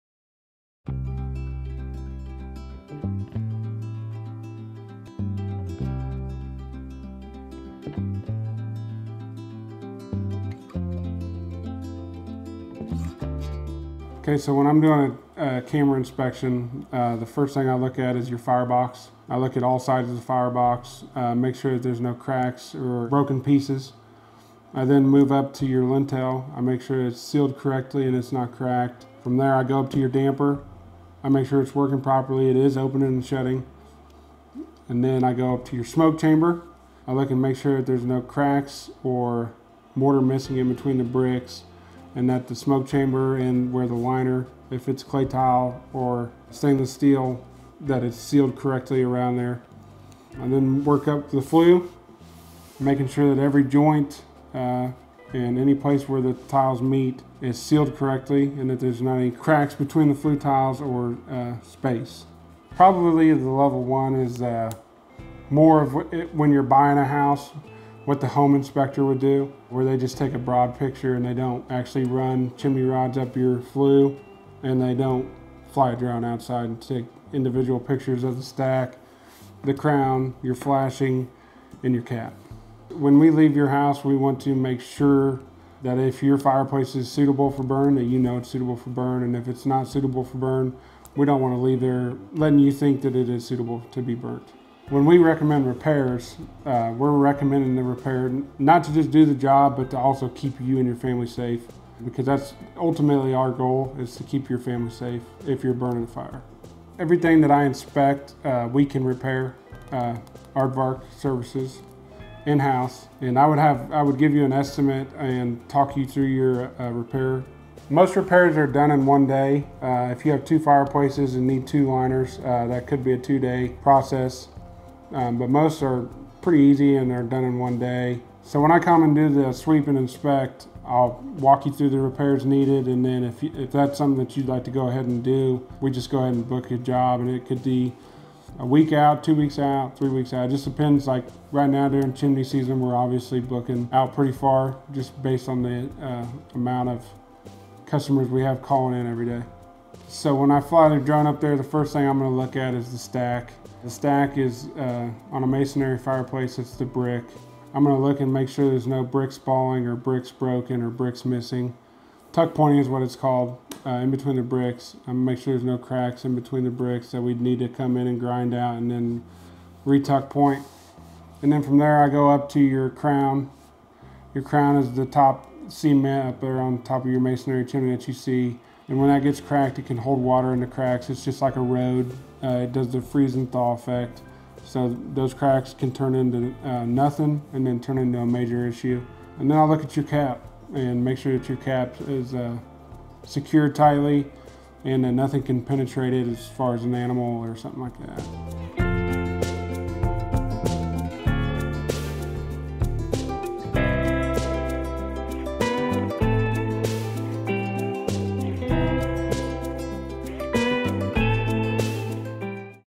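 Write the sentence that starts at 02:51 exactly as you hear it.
And then from there I go up to your crown.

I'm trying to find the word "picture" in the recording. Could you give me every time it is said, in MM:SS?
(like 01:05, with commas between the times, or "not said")
01:10, 01:17.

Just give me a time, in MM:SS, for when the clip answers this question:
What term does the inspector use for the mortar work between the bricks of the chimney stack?
02:42.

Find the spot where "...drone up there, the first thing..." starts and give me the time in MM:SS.
02:30.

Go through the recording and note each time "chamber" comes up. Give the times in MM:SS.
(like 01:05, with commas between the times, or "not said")
00:36, 00:42.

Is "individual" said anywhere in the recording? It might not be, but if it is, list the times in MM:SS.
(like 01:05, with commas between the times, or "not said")
01:17.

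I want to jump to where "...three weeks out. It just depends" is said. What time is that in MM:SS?
02:19.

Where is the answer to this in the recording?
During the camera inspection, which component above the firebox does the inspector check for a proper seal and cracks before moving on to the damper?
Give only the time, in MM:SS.
00:25.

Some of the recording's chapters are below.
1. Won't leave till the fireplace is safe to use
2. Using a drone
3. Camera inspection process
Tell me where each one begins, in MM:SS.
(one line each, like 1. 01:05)
1. 01:30
2. 02:30
3. 00:18.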